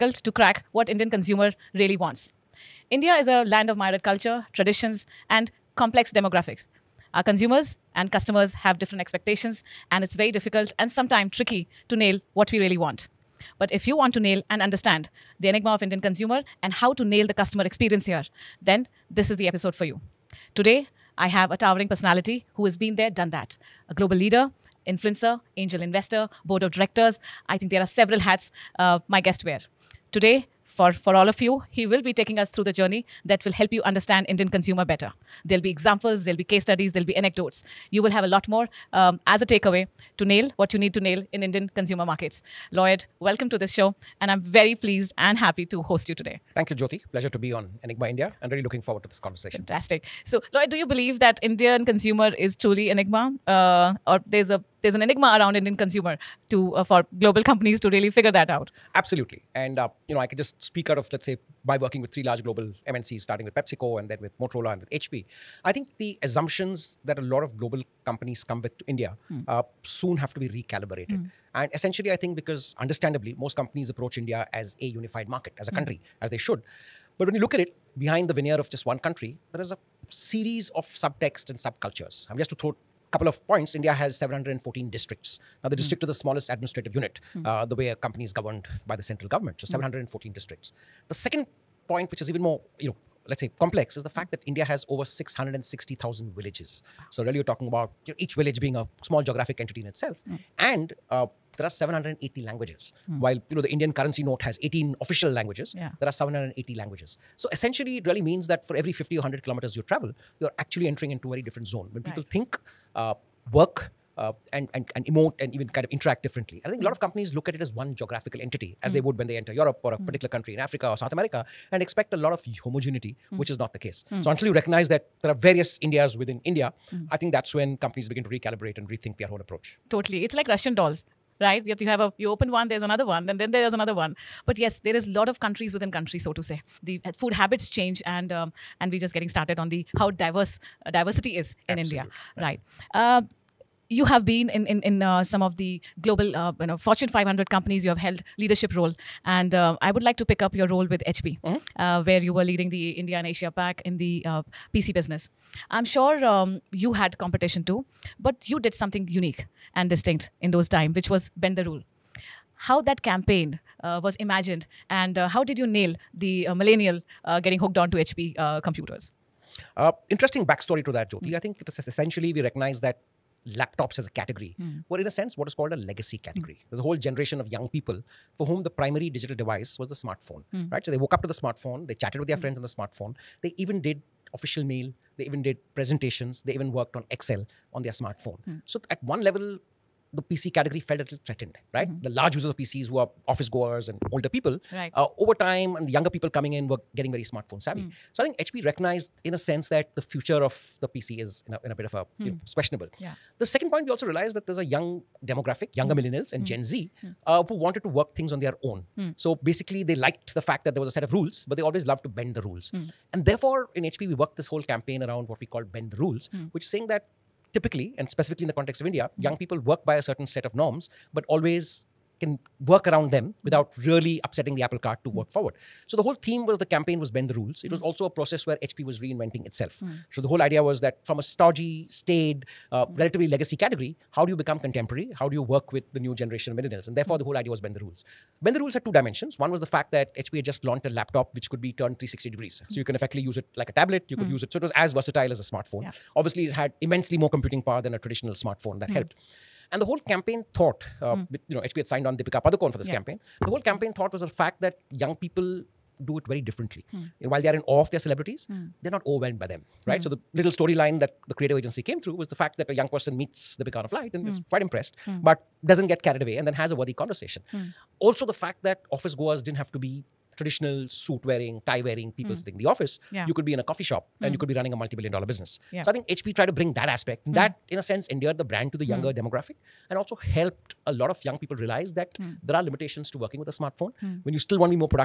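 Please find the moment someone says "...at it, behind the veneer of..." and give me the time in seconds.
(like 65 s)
77 s.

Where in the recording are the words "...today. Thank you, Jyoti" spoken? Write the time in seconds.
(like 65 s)
46 s.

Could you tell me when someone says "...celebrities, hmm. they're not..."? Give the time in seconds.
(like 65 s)
257 s.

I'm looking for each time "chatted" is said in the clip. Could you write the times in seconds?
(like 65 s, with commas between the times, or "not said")
181 s.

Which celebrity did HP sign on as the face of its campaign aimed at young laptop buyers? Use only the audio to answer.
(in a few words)
Deepika Padukone.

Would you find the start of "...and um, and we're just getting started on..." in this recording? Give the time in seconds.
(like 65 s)
138 s.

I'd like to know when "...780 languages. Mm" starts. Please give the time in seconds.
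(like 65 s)
101 s.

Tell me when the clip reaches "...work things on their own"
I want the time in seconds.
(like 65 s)
207 s.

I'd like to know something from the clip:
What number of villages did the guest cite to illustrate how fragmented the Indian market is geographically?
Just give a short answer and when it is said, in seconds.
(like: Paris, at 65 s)
660,000, at 95 s.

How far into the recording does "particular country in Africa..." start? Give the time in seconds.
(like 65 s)
120 s.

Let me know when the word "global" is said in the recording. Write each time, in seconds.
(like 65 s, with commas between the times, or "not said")
23 s, 57 s, 62 s, 67 s, 146 s.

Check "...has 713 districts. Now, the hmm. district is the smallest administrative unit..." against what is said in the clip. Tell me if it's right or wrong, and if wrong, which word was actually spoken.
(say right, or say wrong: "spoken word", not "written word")
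wrong: "714", not "713".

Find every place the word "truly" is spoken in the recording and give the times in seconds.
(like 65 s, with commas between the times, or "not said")
52 s.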